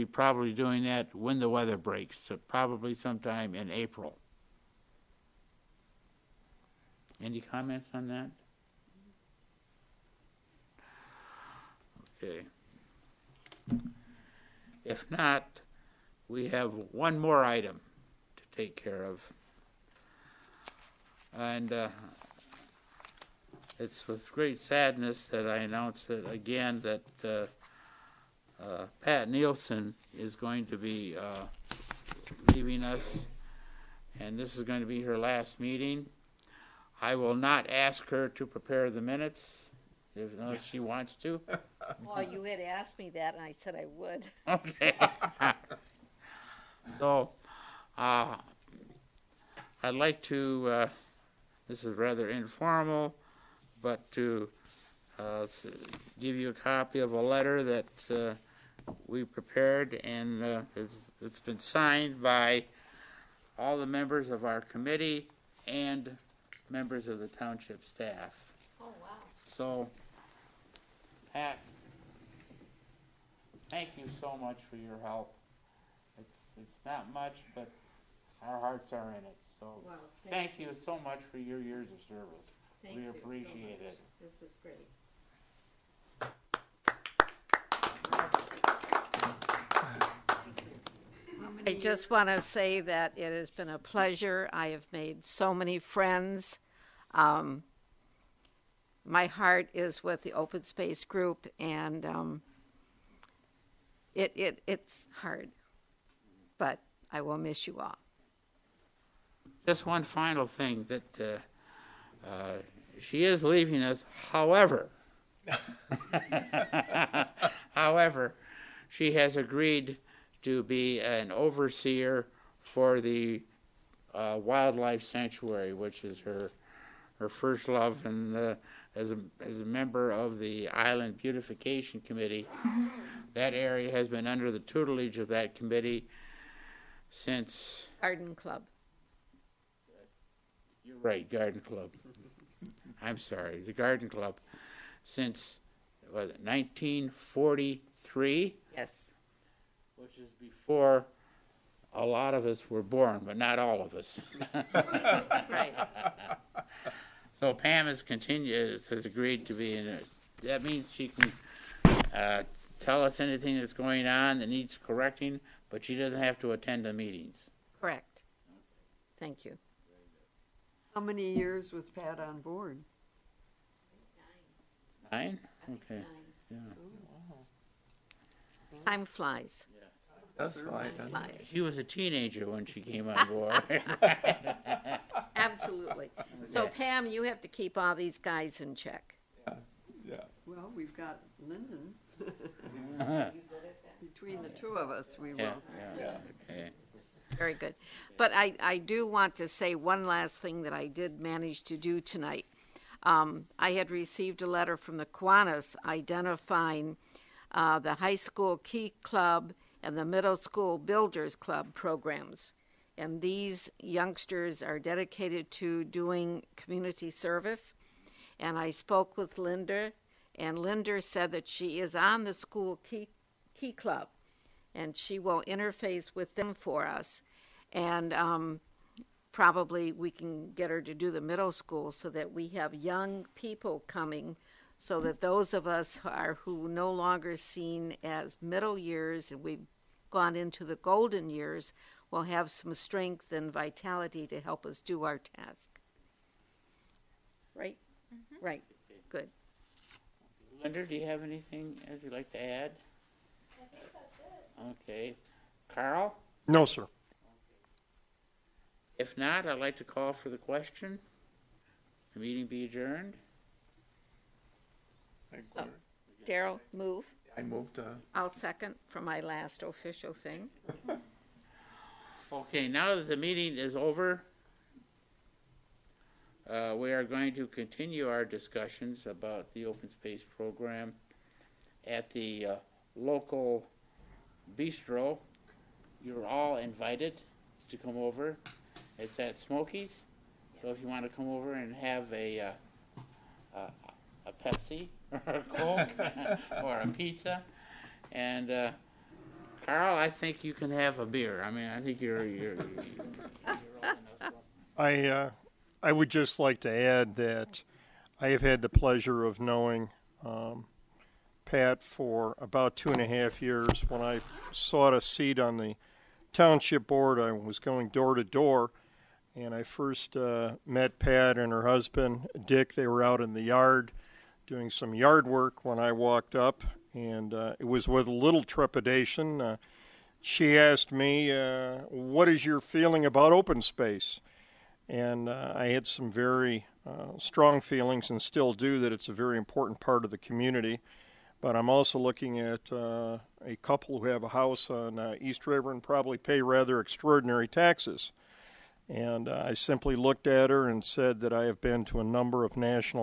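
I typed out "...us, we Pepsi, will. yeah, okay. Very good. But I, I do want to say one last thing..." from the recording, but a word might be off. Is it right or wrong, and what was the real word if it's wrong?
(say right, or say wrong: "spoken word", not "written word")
wrong: "Yeah", not "Pepsi".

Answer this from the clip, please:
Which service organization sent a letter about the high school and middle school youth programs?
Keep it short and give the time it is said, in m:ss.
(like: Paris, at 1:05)
Kiwanis, at 3:25.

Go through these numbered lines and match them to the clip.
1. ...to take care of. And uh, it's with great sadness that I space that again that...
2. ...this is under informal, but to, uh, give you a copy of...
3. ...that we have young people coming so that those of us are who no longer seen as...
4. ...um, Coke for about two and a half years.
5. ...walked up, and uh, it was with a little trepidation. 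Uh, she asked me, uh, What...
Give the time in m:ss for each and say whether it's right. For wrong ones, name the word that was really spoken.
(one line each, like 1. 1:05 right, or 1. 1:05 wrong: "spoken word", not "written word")
1. 0:18 wrong: "announce", not "space"
2. 0:51 wrong: "rather", not "under"
3. 3:52 right
4. 5:10 wrong: "Pat", not "Coke"
5. 5:25 right.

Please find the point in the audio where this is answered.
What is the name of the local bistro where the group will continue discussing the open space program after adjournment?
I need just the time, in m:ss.
4:49.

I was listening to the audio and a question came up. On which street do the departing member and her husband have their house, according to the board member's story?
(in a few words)
East River.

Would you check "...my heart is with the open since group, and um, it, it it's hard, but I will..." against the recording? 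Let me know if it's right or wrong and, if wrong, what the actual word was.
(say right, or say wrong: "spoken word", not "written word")
wrong: "space", not "since".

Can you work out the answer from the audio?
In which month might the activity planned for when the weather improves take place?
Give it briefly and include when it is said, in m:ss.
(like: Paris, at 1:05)
April, at 0:03.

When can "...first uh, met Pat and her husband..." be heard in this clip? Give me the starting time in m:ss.
5:19.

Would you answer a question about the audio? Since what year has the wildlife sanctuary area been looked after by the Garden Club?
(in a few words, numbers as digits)
1943.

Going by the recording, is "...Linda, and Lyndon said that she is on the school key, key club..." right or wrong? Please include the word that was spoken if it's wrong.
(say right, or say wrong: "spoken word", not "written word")
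wrong: "Linda", not "Lyndon".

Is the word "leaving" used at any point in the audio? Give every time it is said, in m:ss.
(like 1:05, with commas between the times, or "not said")
0:32, 1:53.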